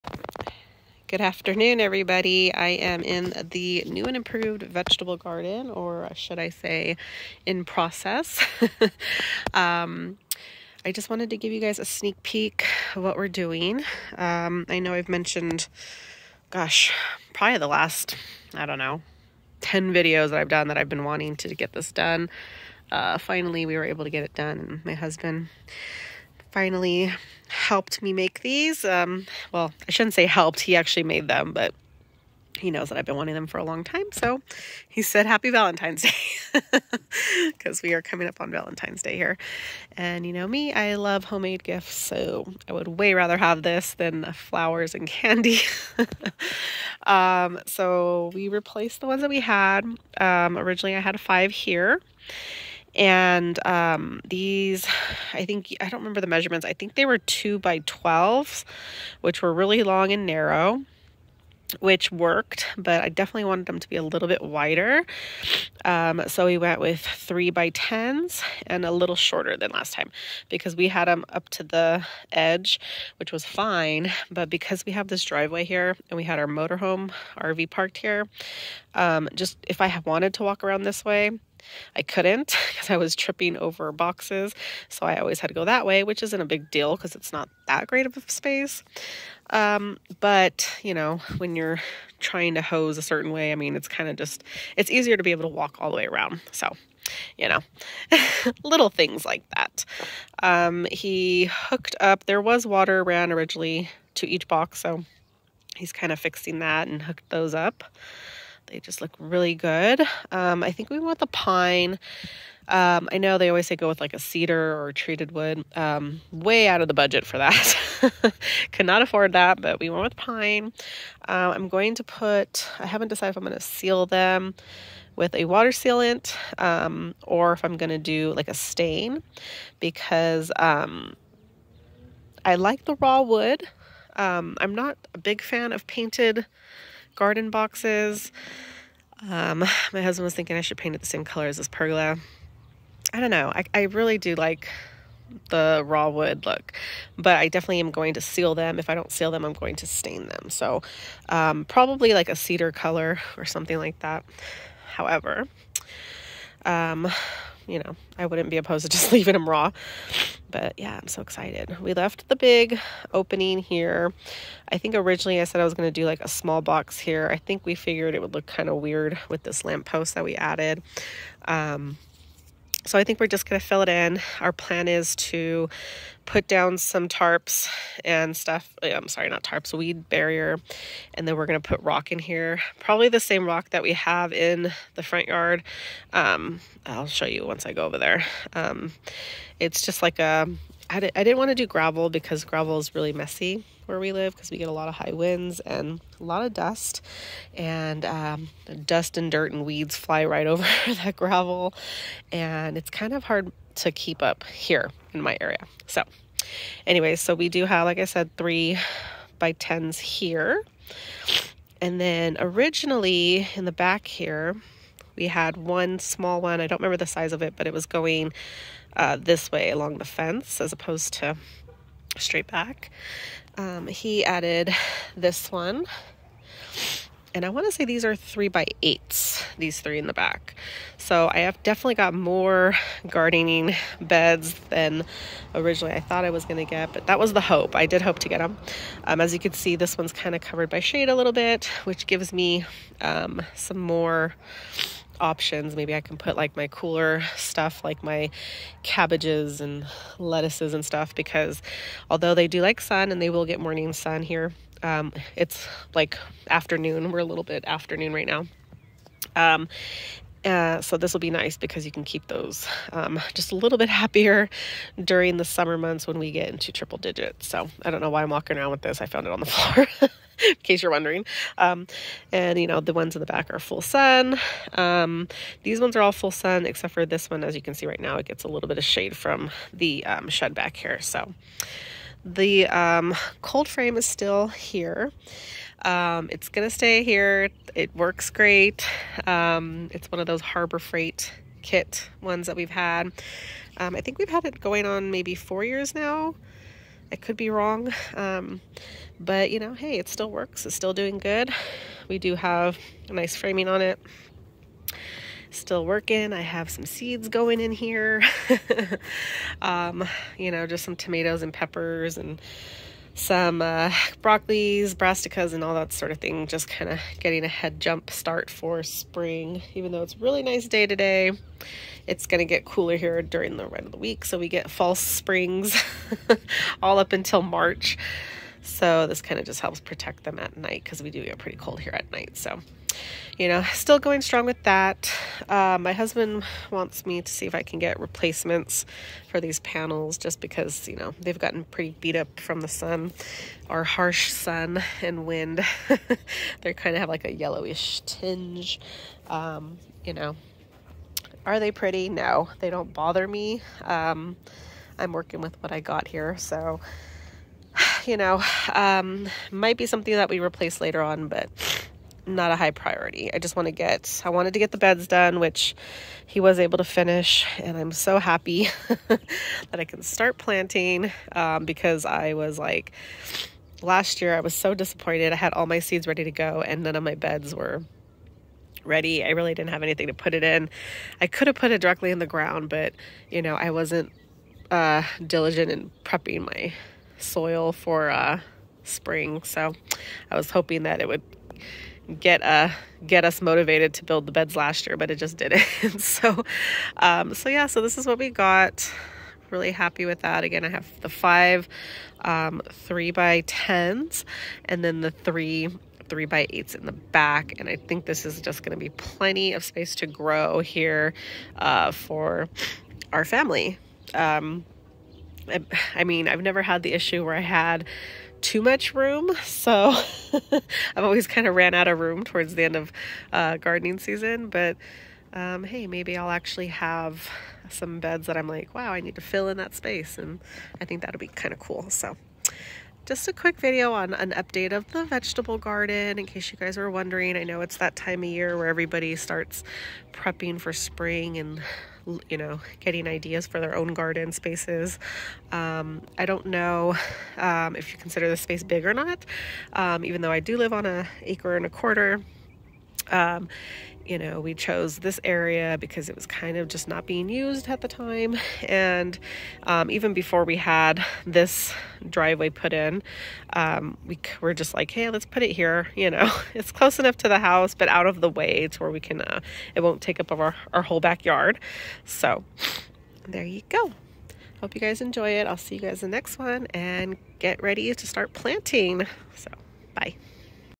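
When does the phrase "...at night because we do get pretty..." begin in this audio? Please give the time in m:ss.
5:30.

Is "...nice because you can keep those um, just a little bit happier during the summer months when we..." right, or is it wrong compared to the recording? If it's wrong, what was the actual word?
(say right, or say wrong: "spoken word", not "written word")
right.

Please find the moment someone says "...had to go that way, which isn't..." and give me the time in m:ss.
1:25.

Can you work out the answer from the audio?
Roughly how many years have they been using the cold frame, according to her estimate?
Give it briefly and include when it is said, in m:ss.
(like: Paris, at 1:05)
4, at 4:55.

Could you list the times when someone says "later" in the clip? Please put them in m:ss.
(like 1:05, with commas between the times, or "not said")
6:00.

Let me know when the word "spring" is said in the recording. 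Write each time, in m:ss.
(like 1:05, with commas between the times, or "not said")
5:18, 5:24, 6:28, 7:20.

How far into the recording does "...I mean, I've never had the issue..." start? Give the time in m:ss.
6:55.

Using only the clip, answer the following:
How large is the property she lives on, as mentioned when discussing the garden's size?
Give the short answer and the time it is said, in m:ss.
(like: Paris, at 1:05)
1.25 acres, at 7:31.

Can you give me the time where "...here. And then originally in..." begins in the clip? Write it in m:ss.
3:29.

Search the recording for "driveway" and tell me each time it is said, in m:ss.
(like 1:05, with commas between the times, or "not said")
1:15, 7:42.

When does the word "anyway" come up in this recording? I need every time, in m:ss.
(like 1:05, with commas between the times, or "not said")
3:26.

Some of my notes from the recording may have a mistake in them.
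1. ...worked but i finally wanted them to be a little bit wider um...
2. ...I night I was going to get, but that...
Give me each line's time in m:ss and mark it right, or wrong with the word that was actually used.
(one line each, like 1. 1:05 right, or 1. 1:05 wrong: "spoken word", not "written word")
1. 1:02 wrong: "definitely", not "finally"
2. 3:55 wrong: "thought", not "night".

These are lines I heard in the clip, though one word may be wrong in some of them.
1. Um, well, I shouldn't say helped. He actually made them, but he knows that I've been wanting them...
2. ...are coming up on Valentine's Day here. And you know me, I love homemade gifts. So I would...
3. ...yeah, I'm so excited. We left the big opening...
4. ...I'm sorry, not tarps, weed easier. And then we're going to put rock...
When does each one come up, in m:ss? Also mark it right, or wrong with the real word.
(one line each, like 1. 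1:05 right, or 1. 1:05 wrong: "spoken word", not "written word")
1. 0:28 right
2. 0:37 right
3. 2:40 right
4. 2:58 wrong: "barrier", not "easier".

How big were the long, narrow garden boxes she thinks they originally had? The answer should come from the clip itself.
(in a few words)
2 by 12.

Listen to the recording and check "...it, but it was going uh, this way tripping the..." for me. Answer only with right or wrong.
wrong.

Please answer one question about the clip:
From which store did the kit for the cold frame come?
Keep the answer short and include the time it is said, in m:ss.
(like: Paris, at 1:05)
Harbor Freight, at 4:50.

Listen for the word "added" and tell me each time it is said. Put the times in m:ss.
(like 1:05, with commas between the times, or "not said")
2:50, 3:44.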